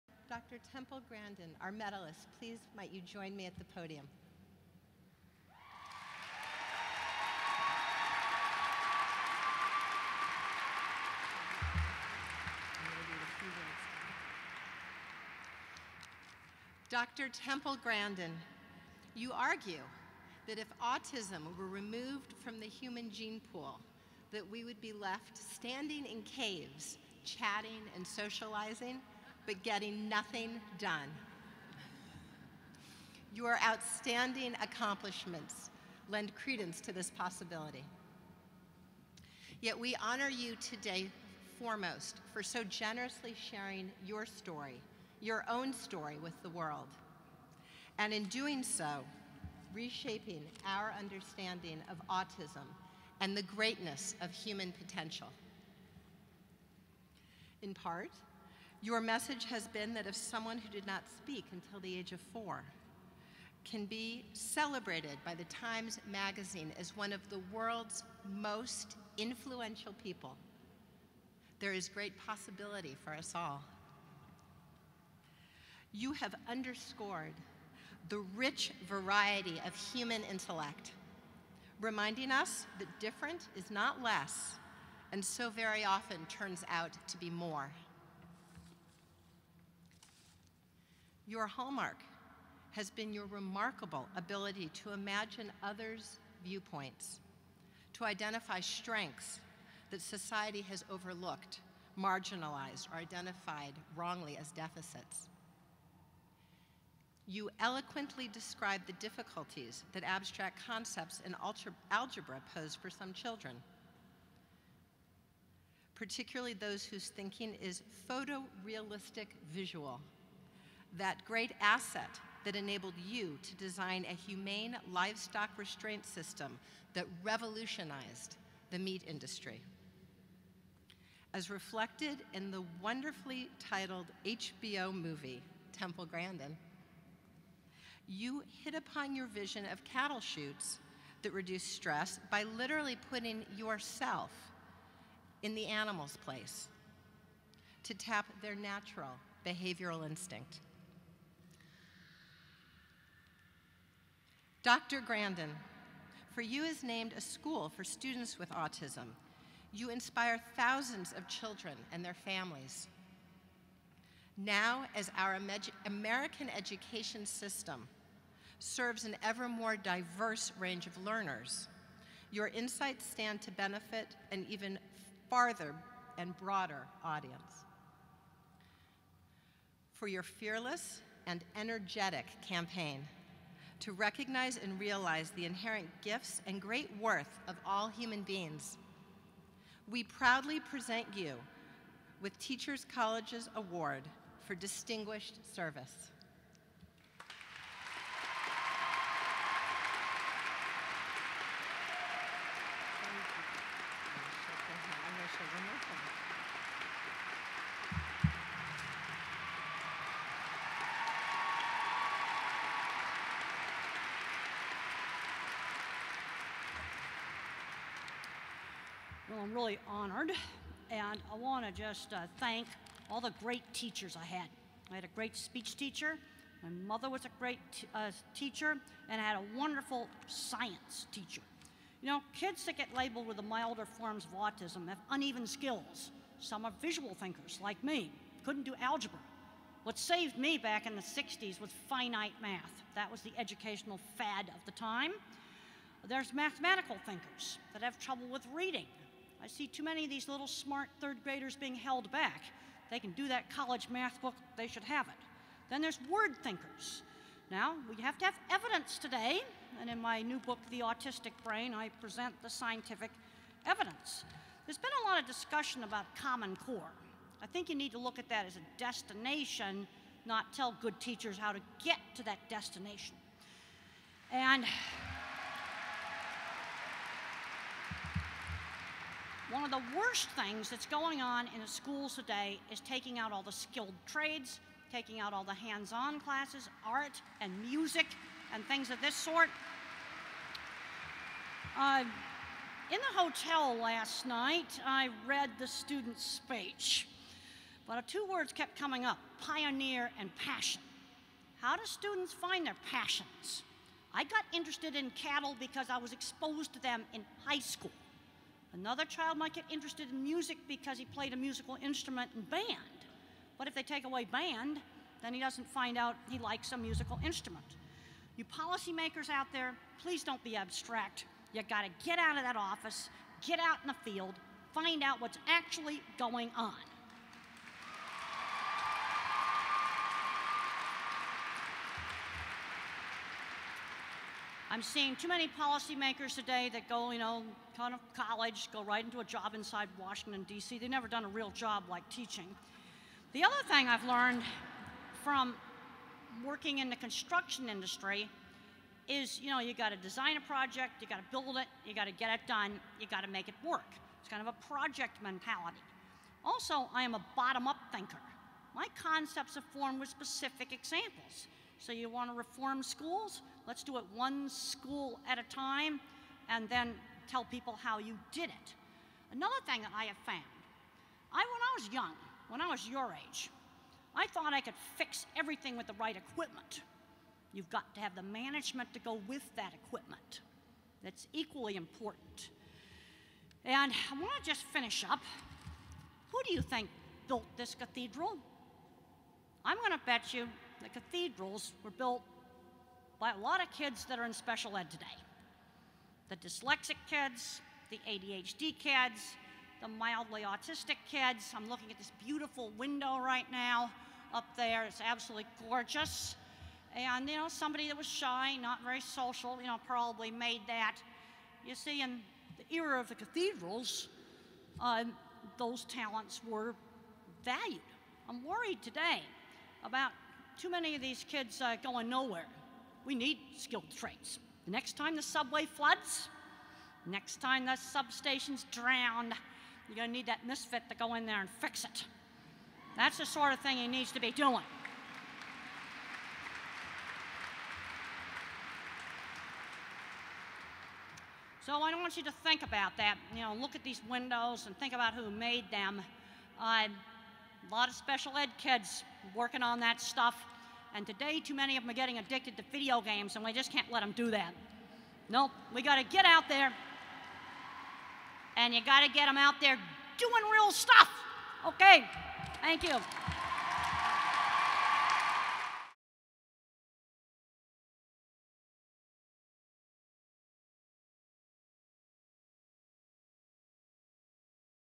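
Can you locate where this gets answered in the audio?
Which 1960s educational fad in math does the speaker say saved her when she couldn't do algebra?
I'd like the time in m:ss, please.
4:01.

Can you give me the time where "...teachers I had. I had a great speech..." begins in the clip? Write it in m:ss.
3:43.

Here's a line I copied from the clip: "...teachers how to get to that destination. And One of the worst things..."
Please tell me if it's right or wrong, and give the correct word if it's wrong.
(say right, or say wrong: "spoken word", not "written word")
right.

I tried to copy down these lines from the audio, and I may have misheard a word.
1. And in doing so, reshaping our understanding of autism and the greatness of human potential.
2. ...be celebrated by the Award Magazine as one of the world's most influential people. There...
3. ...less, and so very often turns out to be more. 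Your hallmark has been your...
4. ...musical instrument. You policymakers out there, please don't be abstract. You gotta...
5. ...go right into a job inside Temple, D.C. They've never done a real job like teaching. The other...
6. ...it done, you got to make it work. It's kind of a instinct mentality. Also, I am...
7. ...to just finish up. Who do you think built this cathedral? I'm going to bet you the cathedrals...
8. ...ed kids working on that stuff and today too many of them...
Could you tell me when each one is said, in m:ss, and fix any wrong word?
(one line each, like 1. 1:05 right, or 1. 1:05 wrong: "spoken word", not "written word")
1. 0:47 right
2. 1:03 wrong: "Times", not "Award"
3. 1:24 right
4. 5:16 right
5. 5:38 wrong: "Washington", not "Temple"
6. 5:52 wrong: "project", not "instinct"
7. 6:24 right
8. 7:28 right.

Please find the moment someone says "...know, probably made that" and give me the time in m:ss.
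6:49.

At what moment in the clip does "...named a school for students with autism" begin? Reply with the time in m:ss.
2:36.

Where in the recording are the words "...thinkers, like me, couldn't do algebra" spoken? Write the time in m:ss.
3:57.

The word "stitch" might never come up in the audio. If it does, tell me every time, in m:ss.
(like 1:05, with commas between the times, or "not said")
not said.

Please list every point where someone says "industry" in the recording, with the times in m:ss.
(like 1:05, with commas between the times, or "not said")
2:09, 5:47.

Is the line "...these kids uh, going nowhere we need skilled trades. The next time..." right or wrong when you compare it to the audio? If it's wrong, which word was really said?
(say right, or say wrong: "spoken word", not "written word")
right.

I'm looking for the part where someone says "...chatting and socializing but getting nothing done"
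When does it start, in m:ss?
0:27.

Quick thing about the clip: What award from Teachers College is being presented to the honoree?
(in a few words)
Award for Distinguished Service.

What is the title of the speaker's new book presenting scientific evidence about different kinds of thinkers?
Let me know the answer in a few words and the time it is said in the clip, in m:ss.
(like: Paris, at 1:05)
The Autistic Brain, at 4:20.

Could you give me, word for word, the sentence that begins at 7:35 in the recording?
Nope, we got to get out there, and you got to get them out there doing real stuff.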